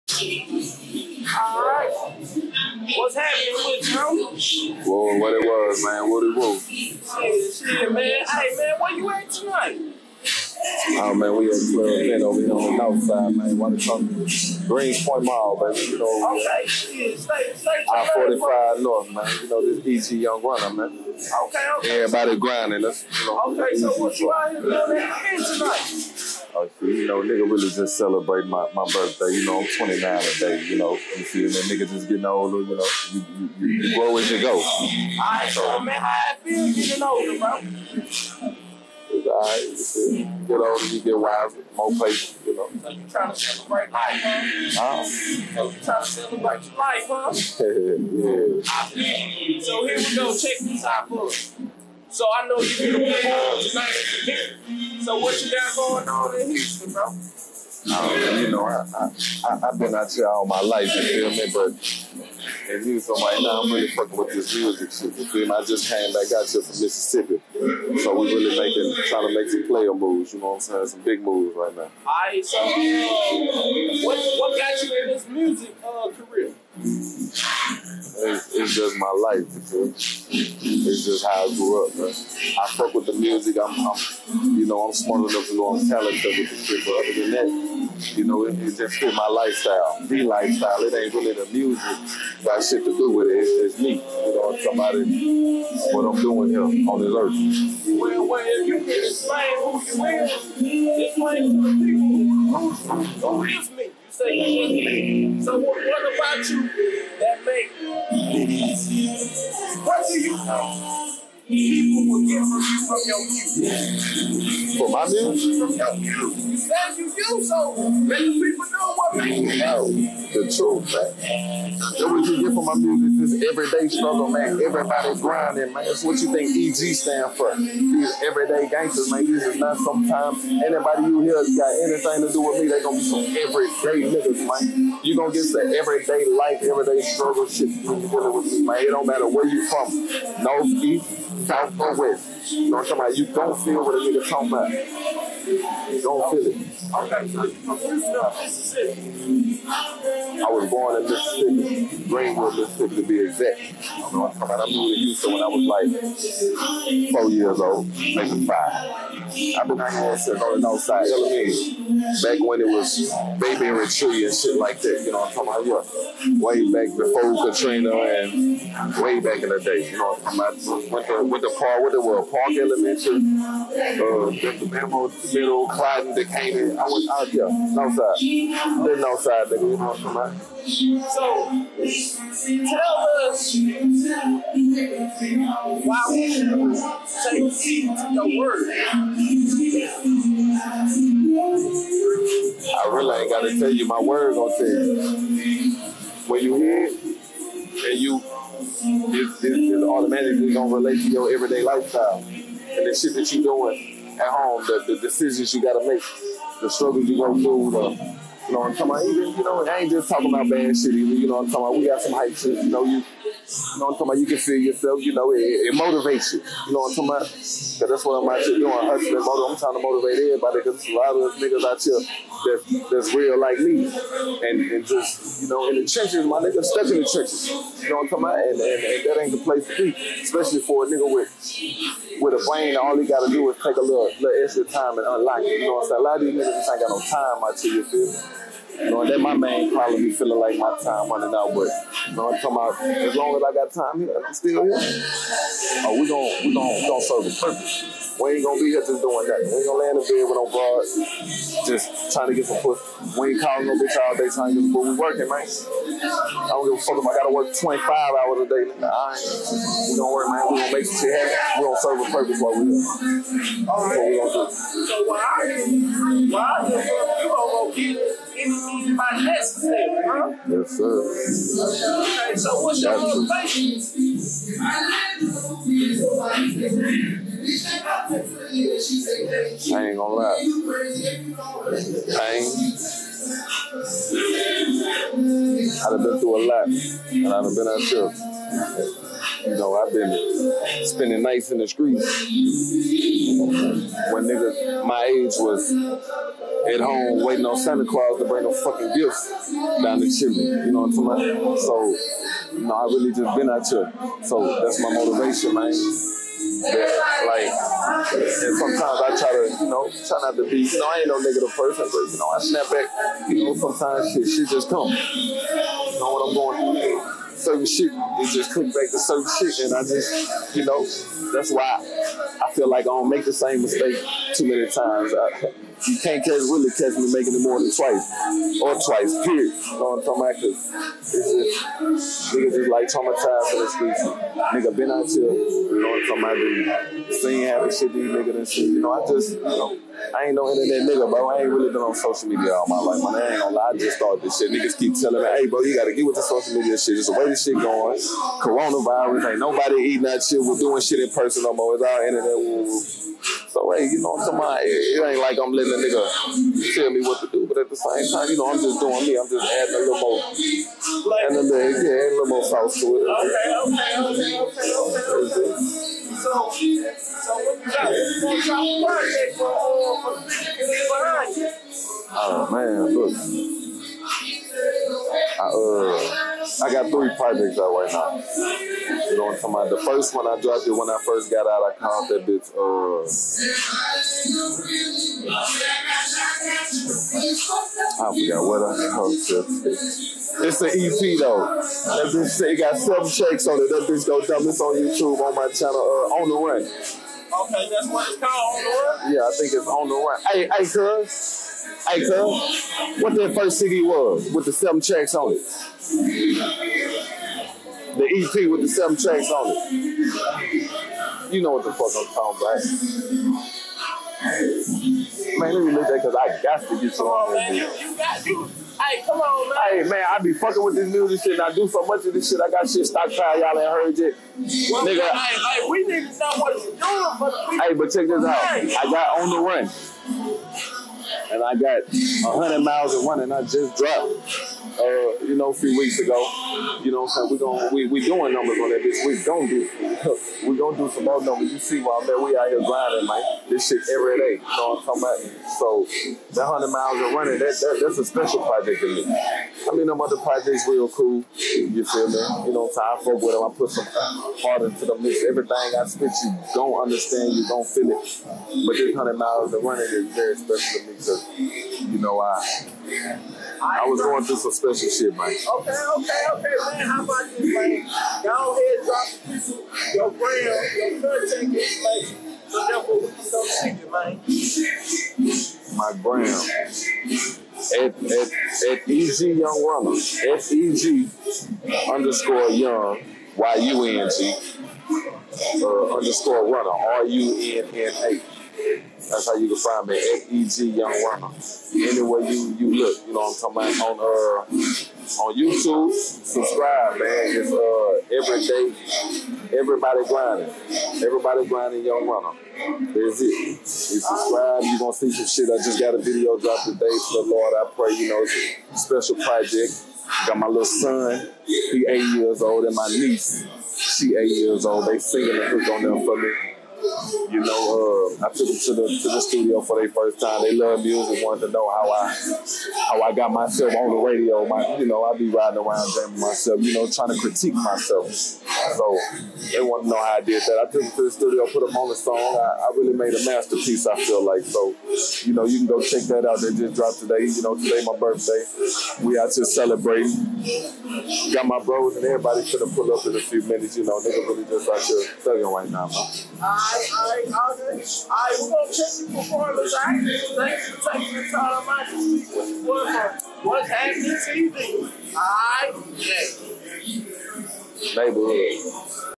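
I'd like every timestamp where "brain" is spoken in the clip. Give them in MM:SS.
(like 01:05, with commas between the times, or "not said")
03:52.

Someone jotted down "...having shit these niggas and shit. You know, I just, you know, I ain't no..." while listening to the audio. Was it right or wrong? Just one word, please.
right.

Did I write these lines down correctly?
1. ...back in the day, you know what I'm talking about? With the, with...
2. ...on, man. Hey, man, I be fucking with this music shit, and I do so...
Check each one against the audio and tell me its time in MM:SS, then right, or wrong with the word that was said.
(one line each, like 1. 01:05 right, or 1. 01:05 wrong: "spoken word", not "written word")
1. 02:49 right
2. 06:59 right.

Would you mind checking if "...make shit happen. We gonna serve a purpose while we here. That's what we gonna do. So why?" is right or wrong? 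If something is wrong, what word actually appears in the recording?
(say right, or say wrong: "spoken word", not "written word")
right.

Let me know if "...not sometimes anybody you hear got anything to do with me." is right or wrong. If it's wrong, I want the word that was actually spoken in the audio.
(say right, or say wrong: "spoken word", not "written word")
right.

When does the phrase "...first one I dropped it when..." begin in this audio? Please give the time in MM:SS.
06:19.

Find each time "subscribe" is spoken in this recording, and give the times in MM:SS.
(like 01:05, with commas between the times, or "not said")
08:15, 08:23.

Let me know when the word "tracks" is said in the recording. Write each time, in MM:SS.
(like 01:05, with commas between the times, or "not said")
06:33, 06:44, 06:48.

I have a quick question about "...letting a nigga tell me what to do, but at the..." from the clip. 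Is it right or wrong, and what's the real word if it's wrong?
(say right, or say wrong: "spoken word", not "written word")
right.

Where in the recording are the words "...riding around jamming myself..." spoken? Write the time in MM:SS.
08:45.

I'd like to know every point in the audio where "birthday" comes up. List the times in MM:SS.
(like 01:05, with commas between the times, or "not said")
00:28, 08:57.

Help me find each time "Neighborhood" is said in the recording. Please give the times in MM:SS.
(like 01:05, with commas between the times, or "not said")
09:18.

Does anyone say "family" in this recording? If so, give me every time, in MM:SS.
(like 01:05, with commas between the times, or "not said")
not said.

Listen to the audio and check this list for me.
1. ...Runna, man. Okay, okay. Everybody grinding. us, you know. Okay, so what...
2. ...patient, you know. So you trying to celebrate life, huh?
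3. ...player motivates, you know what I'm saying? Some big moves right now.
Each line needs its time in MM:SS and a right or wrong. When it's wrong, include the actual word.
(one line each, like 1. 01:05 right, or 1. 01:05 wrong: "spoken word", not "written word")
1. 00:20 right
2. 00:41 right
3. 01:09 wrong: "moves", not "motivates".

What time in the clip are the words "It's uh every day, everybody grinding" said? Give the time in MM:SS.
08:17.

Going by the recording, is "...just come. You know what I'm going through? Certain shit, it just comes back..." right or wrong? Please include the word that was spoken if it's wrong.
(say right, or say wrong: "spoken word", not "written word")
right.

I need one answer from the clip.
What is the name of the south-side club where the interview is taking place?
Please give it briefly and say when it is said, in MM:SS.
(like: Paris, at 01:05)
Club Pen, at 00:11.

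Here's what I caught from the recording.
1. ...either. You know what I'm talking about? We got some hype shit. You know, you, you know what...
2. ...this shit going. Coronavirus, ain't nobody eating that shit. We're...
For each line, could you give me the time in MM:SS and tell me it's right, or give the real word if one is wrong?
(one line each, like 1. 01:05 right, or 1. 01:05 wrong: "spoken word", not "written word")
1. 03:30 right
2. 05:47 right.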